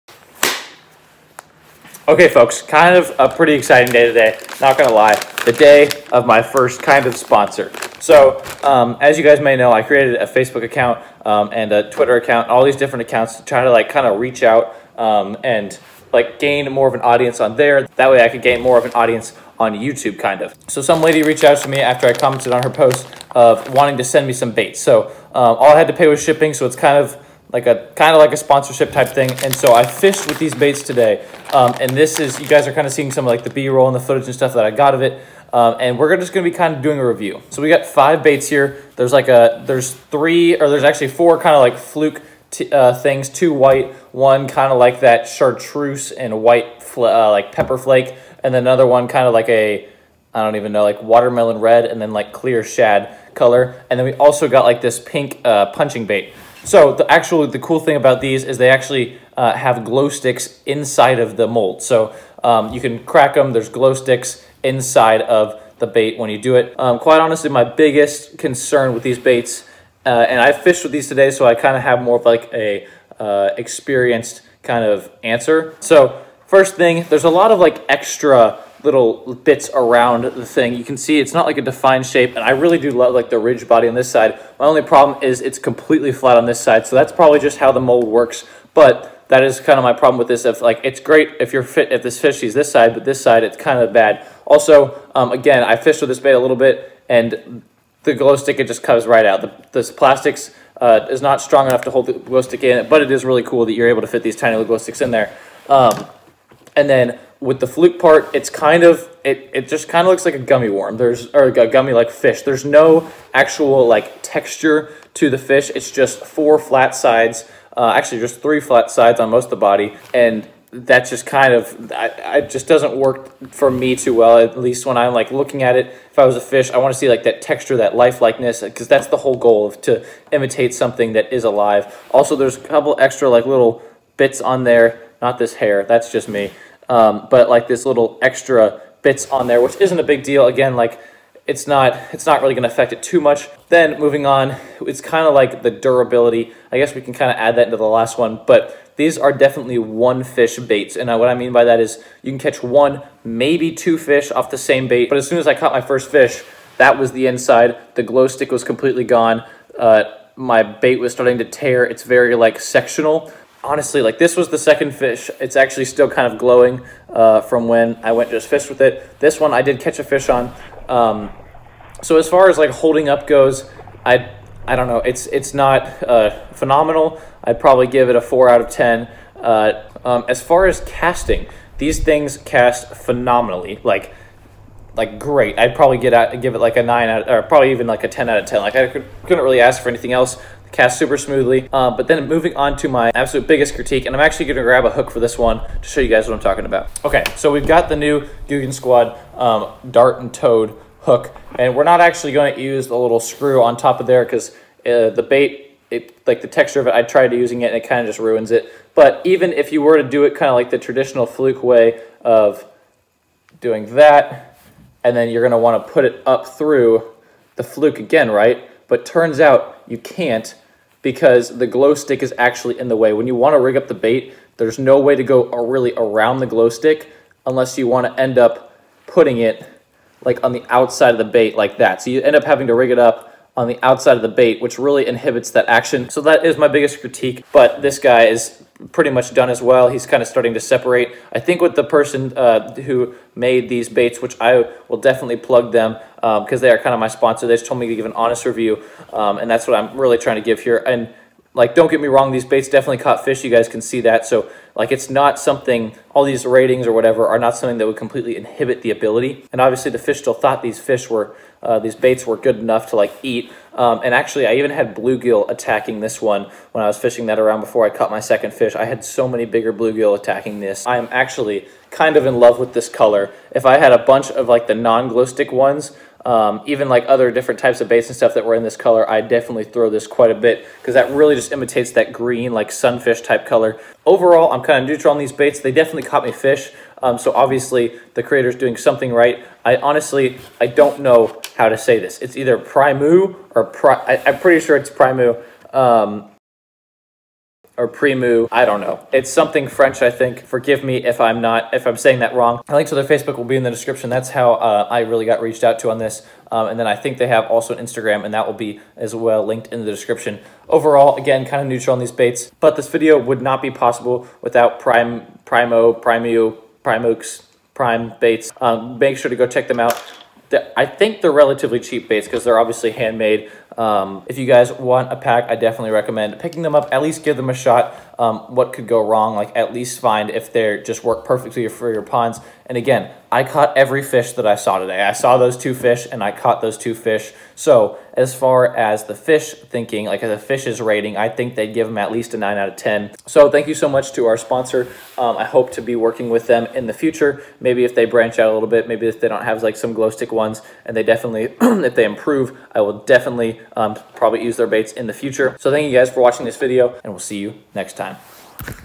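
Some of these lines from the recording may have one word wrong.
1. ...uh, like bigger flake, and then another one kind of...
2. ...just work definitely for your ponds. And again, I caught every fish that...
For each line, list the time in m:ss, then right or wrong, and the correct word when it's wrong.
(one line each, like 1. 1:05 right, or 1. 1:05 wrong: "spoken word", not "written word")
1. 0:46 wrong: "pepper", not "bigger"
2. 5:30 wrong: "perfectly", not "definitely".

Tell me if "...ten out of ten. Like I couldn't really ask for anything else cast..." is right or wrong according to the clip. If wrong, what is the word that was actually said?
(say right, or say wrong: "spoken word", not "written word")
right.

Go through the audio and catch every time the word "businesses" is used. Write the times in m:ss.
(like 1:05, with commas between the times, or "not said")
not said.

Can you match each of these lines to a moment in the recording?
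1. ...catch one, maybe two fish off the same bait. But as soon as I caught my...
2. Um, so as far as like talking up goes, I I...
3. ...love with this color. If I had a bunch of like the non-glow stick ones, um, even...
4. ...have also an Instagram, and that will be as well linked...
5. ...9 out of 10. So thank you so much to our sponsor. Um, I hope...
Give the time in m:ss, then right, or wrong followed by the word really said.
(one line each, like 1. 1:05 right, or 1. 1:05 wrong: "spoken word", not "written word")
1. 2:32 right
2. 2:50 wrong: "holding", not "talking"
3. 4:32 right
4. 5:07 right
5. 5:42 right.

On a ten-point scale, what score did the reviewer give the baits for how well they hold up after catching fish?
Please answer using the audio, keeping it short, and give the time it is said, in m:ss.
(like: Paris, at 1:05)
4, at 2:58.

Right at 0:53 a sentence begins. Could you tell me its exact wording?
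And then we also got like this pink uh, punching bait.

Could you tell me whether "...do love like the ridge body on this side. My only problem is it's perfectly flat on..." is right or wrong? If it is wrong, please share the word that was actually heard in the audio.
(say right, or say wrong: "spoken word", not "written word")
wrong: "completely", not "perfectly".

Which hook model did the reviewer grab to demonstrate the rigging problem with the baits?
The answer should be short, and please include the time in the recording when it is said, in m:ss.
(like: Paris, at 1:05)
Dart and Toad hook, at 3:19.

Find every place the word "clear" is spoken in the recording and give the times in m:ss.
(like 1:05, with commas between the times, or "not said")
0:52.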